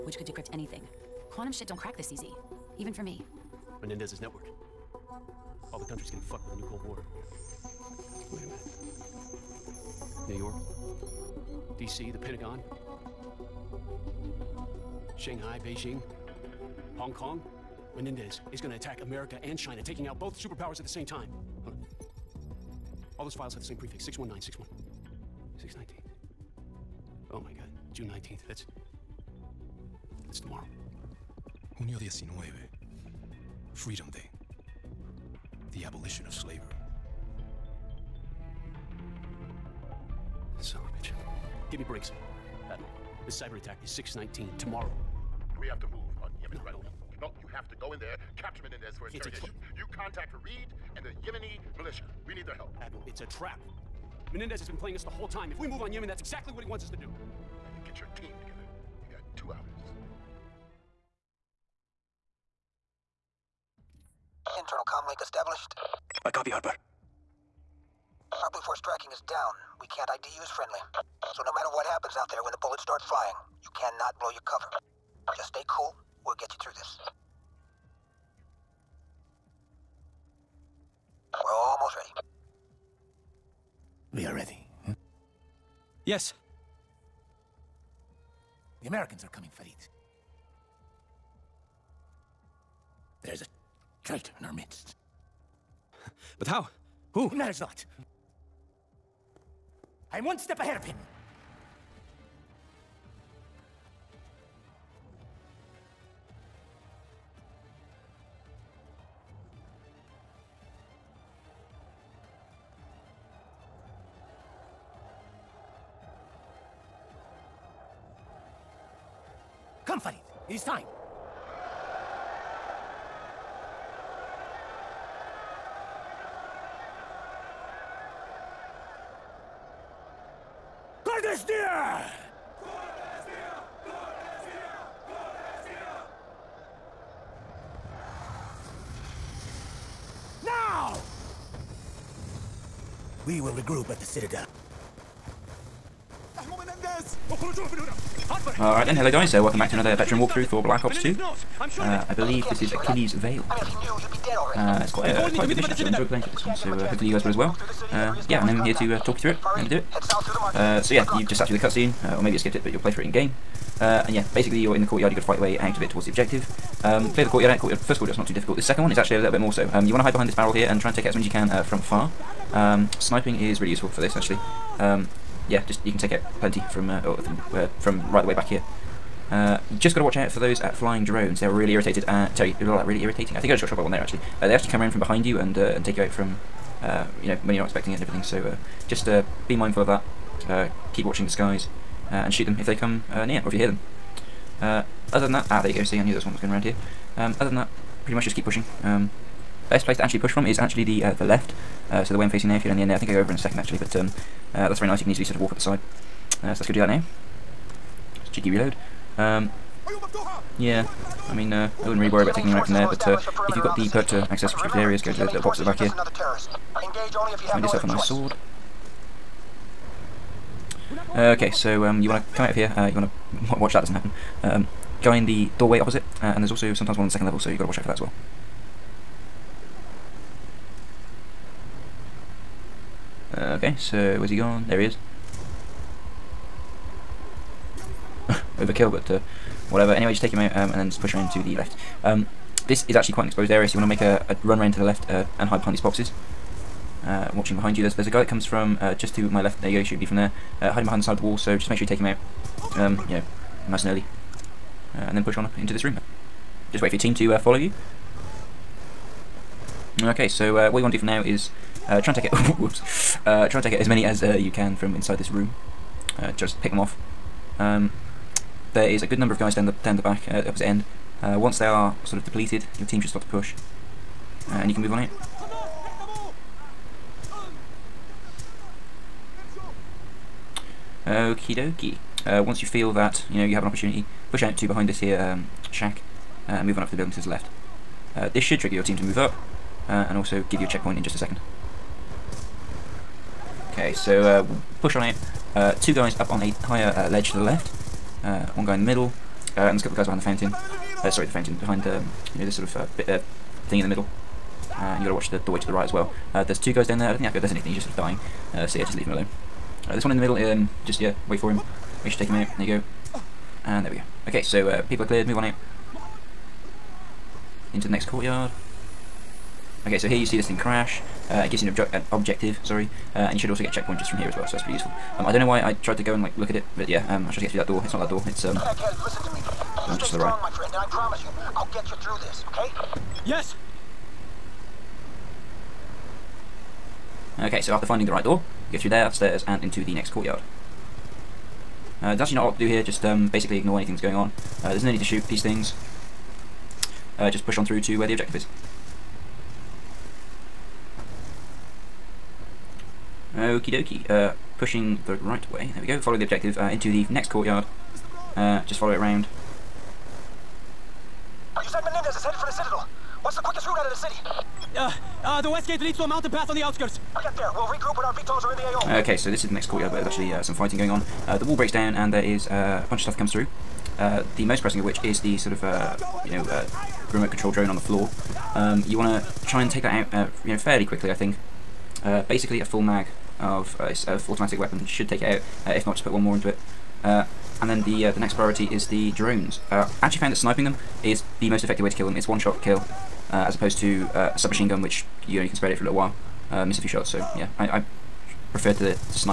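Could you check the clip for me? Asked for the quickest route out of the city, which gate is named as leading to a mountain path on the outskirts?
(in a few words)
The west gate.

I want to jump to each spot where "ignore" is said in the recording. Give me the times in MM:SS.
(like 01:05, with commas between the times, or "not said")
05:43.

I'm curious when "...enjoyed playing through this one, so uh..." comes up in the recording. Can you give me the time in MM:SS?
02:35.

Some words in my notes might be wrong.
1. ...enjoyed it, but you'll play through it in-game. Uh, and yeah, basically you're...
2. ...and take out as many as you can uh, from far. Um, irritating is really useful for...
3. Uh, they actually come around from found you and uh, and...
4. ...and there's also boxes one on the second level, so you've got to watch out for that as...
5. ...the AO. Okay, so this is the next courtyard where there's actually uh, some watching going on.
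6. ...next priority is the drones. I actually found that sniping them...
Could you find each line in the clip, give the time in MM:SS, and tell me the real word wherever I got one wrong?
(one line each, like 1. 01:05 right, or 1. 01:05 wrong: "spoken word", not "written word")
1. 02:42 wrong: "skipped", not "enjoyed"
2. 02:50 wrong: "sniping", not "irritating"
3. 03:04 wrong: "behind", not "found"
4. 03:46 wrong: "sometimes", not "boxes"
5. 06:08 wrong: "fighting", not "watching"
6. 06:28 right.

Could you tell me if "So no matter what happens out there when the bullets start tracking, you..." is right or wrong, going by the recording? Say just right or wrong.
wrong.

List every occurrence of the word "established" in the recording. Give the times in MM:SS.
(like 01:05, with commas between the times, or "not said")
01:05.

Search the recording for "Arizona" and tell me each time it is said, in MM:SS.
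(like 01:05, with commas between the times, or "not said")
not said.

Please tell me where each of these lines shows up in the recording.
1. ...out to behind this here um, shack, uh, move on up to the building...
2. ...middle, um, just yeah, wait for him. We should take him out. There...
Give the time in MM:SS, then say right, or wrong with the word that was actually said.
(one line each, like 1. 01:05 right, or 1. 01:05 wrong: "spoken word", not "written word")
1. 04:44 right
2. 05:10 right.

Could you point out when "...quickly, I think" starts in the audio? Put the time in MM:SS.
06:20.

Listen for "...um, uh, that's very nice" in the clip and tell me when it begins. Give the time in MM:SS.
03:23.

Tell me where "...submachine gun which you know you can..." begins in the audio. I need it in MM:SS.
06:34.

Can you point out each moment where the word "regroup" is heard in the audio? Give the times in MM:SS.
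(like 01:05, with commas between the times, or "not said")
02:23, 06:07.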